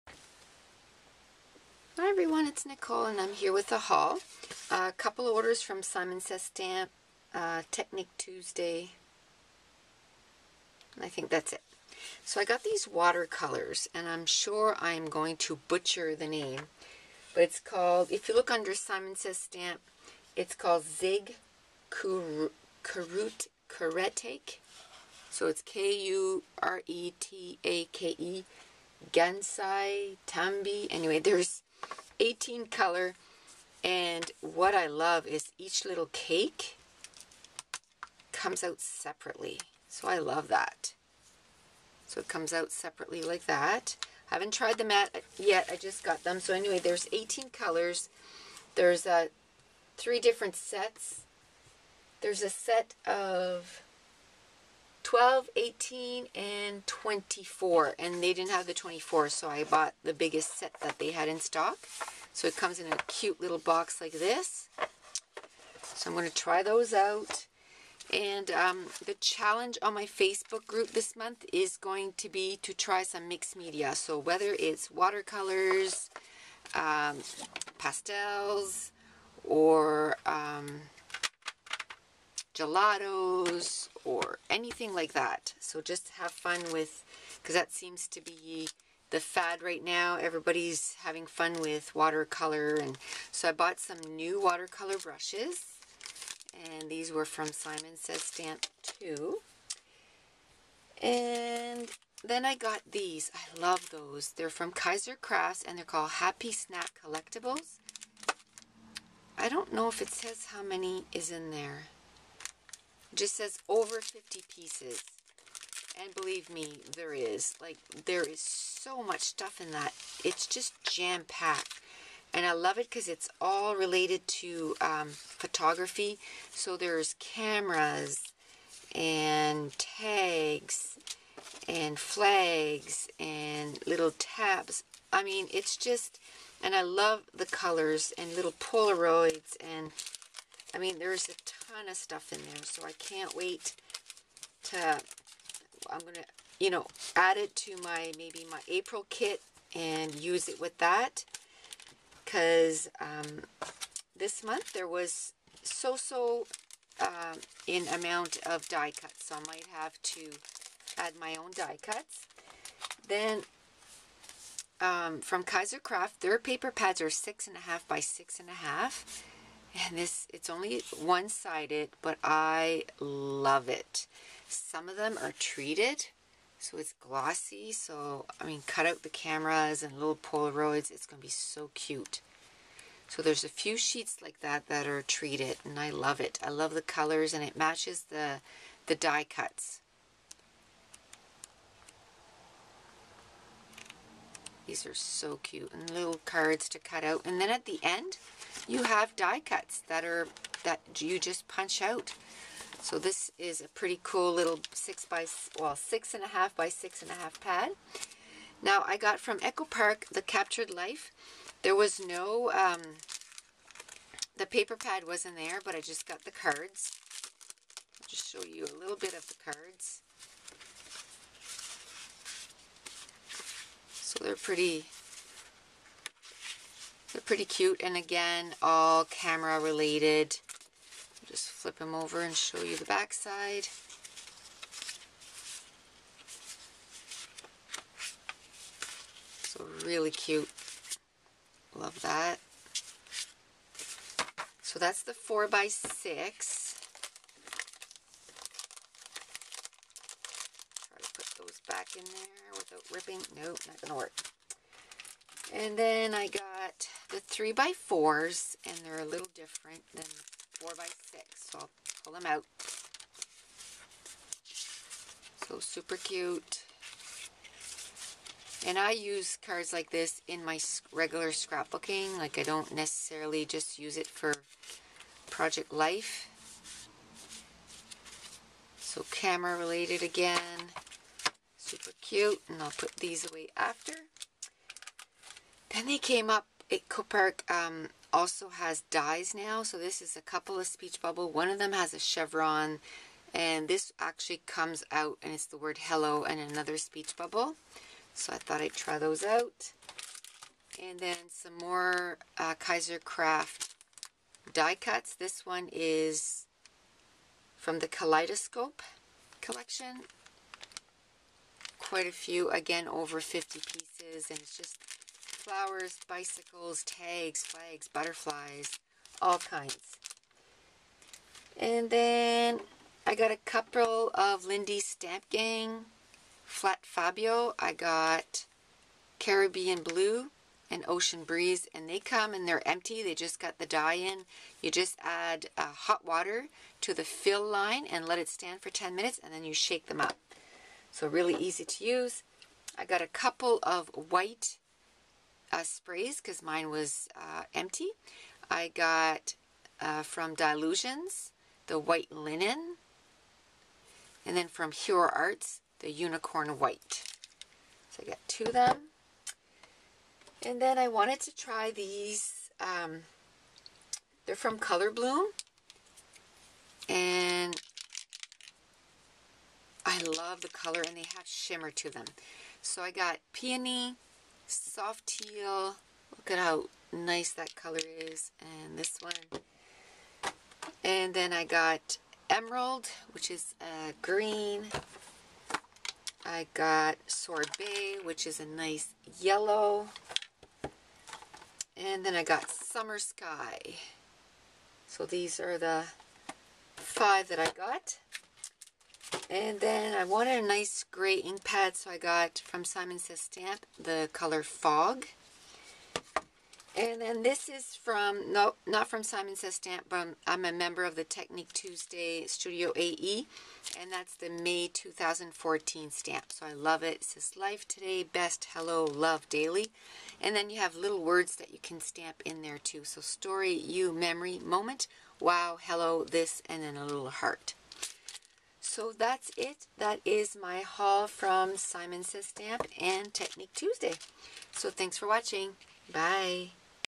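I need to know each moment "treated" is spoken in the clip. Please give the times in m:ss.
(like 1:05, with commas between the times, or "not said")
2:55, 3:05.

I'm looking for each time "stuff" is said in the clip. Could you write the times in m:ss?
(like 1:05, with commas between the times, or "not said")
1:59, 2:21.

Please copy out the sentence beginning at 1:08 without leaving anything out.
And um, the challenge on my Facebook group this month is going to be to try some mixed media.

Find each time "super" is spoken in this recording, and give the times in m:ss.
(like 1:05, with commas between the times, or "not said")
4:25, 4:41.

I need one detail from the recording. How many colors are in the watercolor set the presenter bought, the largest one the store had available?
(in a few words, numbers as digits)
18.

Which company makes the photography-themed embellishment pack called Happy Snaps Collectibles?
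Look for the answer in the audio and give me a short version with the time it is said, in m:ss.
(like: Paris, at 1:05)
Kaiser Crafts, at 1:44.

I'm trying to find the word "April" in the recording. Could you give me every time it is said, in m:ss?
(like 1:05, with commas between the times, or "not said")
2:28.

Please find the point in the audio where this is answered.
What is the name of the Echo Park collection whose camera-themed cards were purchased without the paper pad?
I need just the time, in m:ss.
3:30.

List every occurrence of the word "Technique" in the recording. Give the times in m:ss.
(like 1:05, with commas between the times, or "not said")
0:07, 6:51, 7:13.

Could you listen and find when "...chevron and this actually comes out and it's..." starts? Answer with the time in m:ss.
4:51.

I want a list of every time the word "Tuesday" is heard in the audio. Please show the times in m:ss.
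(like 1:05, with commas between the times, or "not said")
0:08, 6:51, 7:13.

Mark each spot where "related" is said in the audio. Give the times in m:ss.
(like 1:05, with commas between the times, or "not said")
2:03, 3:49, 4:39.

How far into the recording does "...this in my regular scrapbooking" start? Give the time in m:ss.
4:29.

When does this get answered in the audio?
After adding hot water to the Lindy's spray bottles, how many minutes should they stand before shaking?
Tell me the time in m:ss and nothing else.
5:38.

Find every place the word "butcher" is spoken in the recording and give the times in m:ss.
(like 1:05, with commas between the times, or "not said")
0:15.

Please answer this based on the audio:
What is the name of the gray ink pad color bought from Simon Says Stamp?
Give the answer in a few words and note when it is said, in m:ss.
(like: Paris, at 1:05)
Fog, at 6:44.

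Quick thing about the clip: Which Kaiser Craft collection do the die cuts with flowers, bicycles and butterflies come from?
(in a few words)
Kaleidoscope.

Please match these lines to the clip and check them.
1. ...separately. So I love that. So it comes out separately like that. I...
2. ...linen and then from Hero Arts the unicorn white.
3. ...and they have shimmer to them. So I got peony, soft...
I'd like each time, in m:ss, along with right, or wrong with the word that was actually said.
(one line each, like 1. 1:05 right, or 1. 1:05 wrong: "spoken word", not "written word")
1. 0:38 right
2. 5:52 right
3. 6:10 right.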